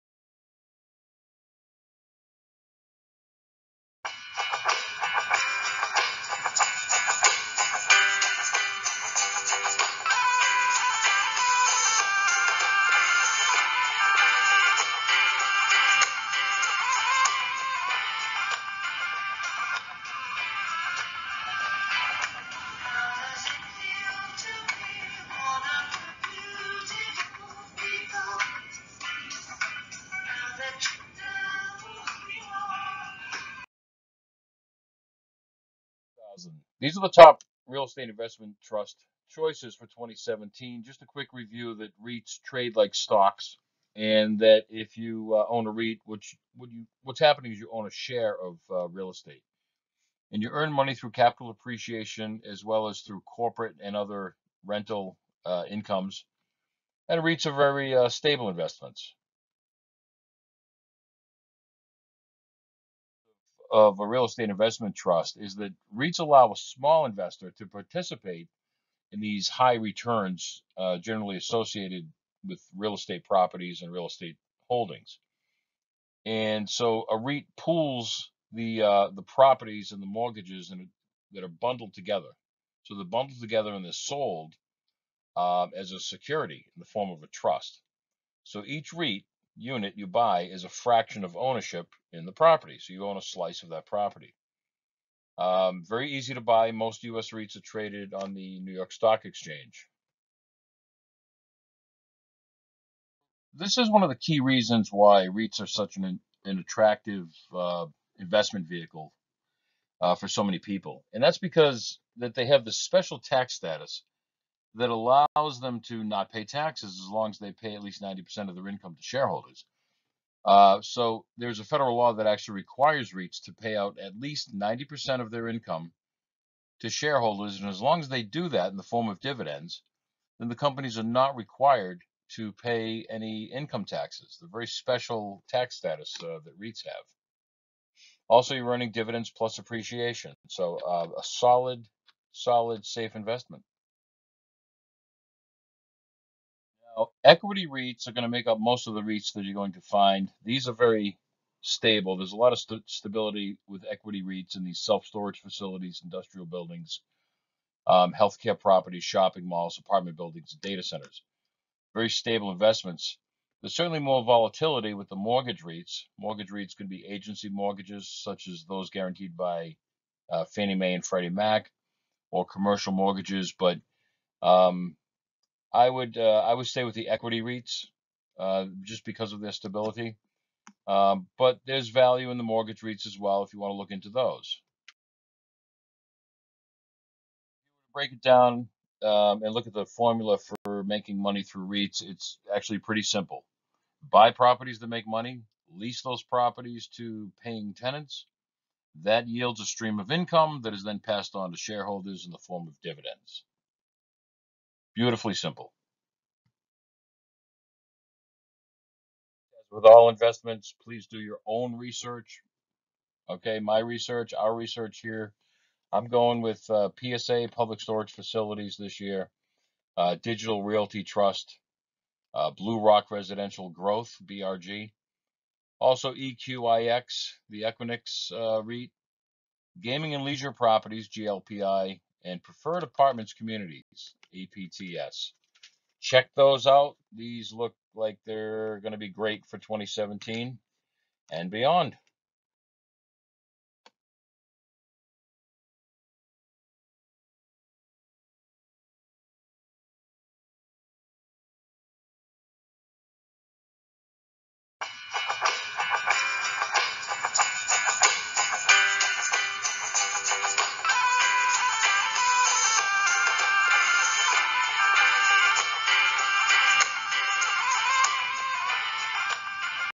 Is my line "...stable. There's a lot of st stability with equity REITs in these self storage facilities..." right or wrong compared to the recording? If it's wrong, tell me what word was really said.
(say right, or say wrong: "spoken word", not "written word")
right.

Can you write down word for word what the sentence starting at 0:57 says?
And REITs are very uh, stable investments.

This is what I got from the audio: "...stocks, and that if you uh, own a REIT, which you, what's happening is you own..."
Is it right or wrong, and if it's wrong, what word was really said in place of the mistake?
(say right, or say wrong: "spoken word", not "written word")
right.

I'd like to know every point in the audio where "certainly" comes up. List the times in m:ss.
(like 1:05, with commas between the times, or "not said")
2:43.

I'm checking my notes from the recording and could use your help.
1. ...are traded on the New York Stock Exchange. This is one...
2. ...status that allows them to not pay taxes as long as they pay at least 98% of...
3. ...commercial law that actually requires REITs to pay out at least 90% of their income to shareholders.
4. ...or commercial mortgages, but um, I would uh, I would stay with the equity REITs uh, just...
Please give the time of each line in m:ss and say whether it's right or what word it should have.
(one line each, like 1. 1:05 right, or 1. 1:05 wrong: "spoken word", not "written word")
1. 1:37 right
2. 1:53 wrong: "90", not "98"
3. 2:01 wrong: "federal", not "commercial"
4. 2:52 right.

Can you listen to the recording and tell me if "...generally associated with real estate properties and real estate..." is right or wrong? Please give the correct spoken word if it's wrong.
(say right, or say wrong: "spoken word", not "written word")
right.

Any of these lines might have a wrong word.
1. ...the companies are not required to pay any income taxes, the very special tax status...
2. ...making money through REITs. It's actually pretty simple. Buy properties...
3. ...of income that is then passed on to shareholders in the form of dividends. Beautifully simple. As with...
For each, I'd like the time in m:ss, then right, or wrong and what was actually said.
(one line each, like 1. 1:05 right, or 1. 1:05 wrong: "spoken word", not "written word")
1. 2:10 right
2. 3:10 right
3. 3:19 right.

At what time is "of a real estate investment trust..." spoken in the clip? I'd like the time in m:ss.
1:03.